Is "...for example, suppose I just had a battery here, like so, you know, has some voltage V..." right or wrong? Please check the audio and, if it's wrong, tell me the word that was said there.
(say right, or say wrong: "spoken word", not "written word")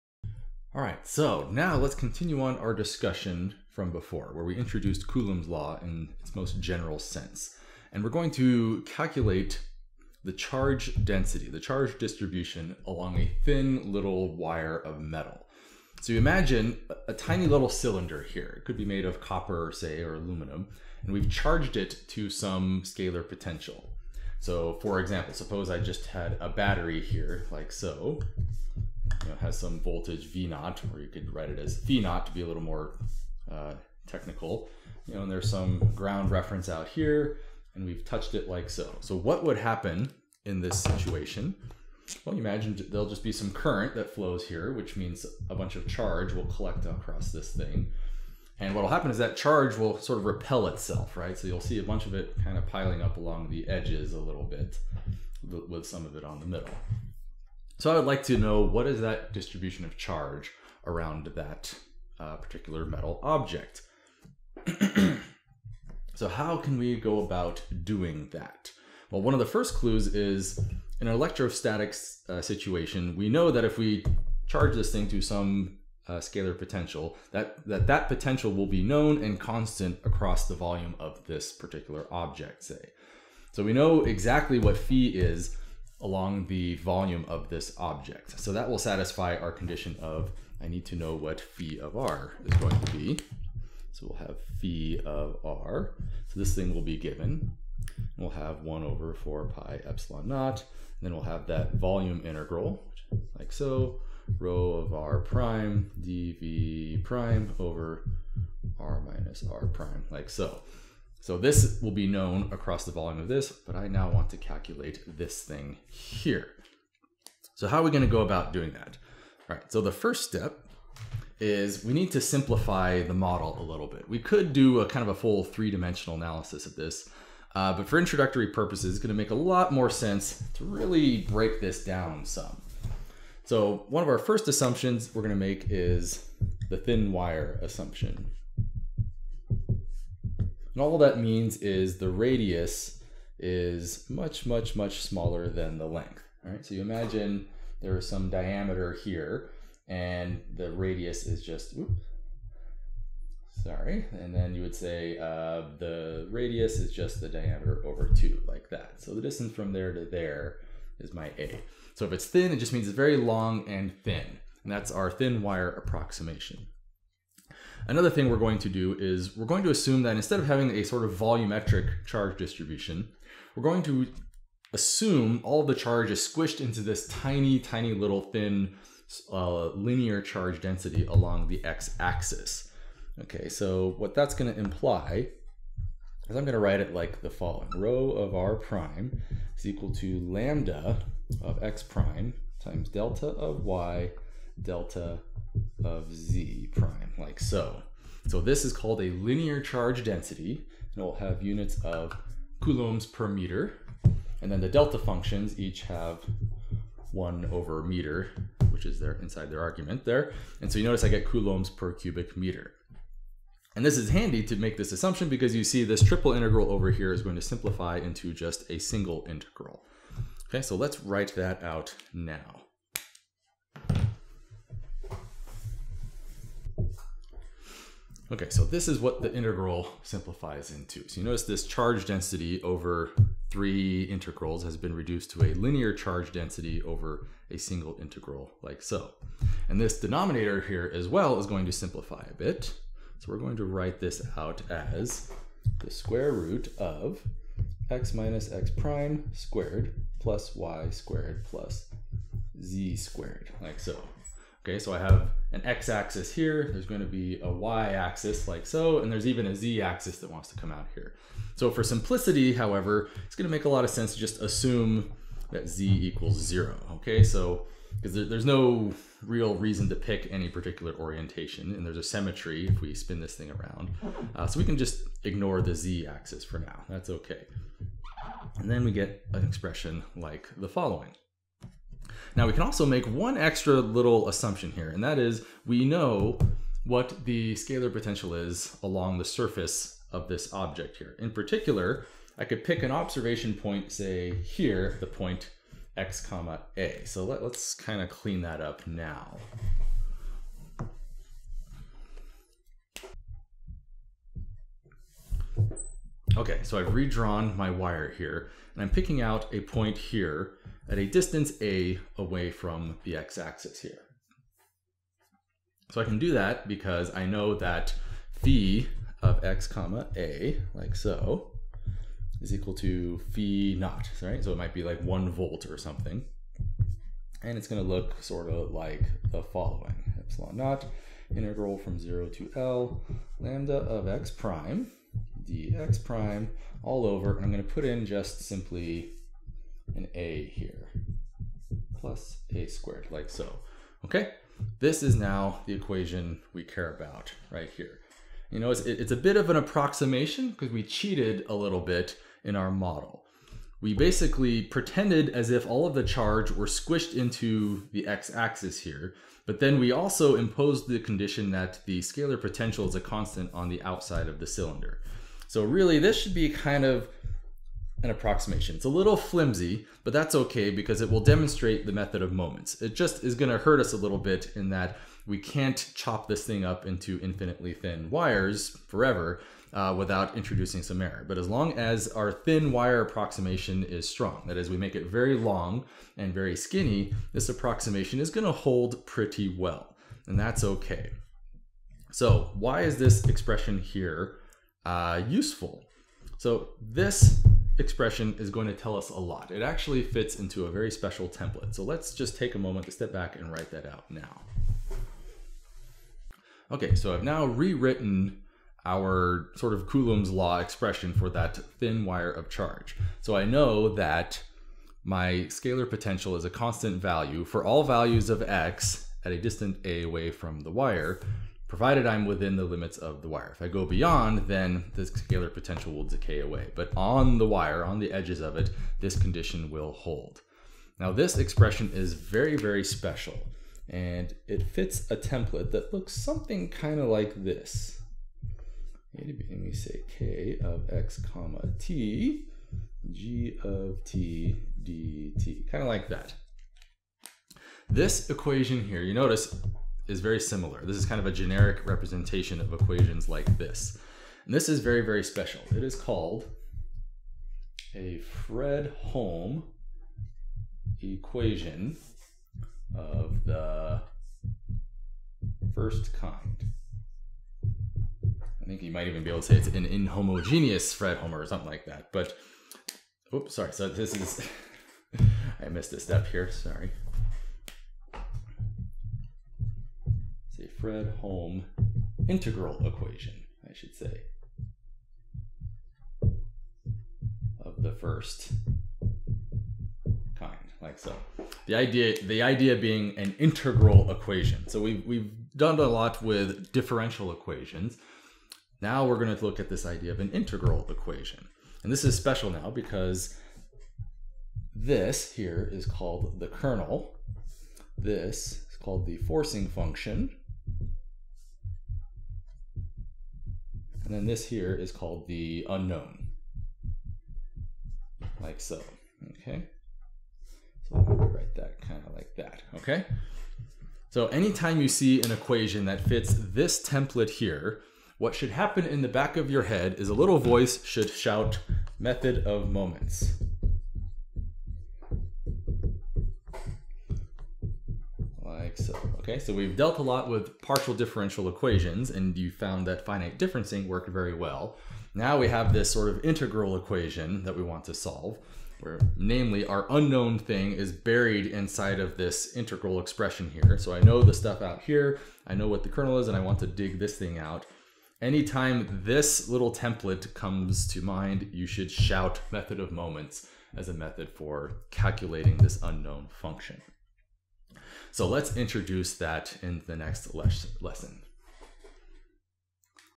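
right.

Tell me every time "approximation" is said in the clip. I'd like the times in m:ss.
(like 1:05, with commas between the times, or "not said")
2:45, 5:49, 6:08, 6:23, 6:27.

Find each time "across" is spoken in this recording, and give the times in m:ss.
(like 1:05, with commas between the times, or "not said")
0:46, 1:20, 1:52.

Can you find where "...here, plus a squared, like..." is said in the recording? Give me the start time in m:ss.
5:40.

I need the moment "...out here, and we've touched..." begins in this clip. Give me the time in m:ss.
0:36.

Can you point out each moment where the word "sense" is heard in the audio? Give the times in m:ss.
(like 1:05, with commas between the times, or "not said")
0:06, 2:09, 4:23.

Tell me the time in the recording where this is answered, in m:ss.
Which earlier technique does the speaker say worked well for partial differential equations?
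9:03.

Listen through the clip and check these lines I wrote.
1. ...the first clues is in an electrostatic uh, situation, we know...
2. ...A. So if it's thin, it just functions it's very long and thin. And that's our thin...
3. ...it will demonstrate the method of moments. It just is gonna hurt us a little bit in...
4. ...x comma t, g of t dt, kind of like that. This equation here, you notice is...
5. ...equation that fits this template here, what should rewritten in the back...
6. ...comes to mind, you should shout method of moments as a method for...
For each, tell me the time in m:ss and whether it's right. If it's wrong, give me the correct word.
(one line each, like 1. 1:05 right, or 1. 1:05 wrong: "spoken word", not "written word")
1. 1:09 right
2. 2:41 wrong: "means", not "functions"
3. 6:11 right
4. 7:20 right
5. 8:45 wrong: "happen", not "rewritten"
6. 9:20 right.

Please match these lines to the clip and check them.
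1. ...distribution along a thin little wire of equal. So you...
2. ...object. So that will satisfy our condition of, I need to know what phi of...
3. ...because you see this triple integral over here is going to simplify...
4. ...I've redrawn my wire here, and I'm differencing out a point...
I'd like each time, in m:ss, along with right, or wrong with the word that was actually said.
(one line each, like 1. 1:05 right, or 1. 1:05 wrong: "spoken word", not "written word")
1. 0:11 wrong: "metal", not "equal"
2. 1:27 right
3. 3:35 right
4. 5:06 wrong: "picking", not "differencing".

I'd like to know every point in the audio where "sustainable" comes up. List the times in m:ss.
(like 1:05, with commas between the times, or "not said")
not said.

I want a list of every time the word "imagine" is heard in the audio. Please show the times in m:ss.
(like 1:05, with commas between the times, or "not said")
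0:16, 0:42, 2:26.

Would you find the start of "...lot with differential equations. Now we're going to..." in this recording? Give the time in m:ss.
8:15.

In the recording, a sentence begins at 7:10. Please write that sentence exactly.
Now this expression is very, very special, and it fits a template that looks something kind of like this.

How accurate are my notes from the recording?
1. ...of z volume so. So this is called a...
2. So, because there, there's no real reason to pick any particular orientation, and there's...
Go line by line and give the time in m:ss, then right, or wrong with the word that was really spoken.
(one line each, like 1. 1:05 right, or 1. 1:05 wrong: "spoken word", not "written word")
1. 3:15 wrong: "prime", not "volume"
2. 4:27 right.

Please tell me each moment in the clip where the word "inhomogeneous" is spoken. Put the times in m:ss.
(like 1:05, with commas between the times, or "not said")
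7:49.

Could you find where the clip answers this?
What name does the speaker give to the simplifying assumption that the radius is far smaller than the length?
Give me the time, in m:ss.
2:16.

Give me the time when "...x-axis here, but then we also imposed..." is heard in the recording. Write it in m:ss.
5:58.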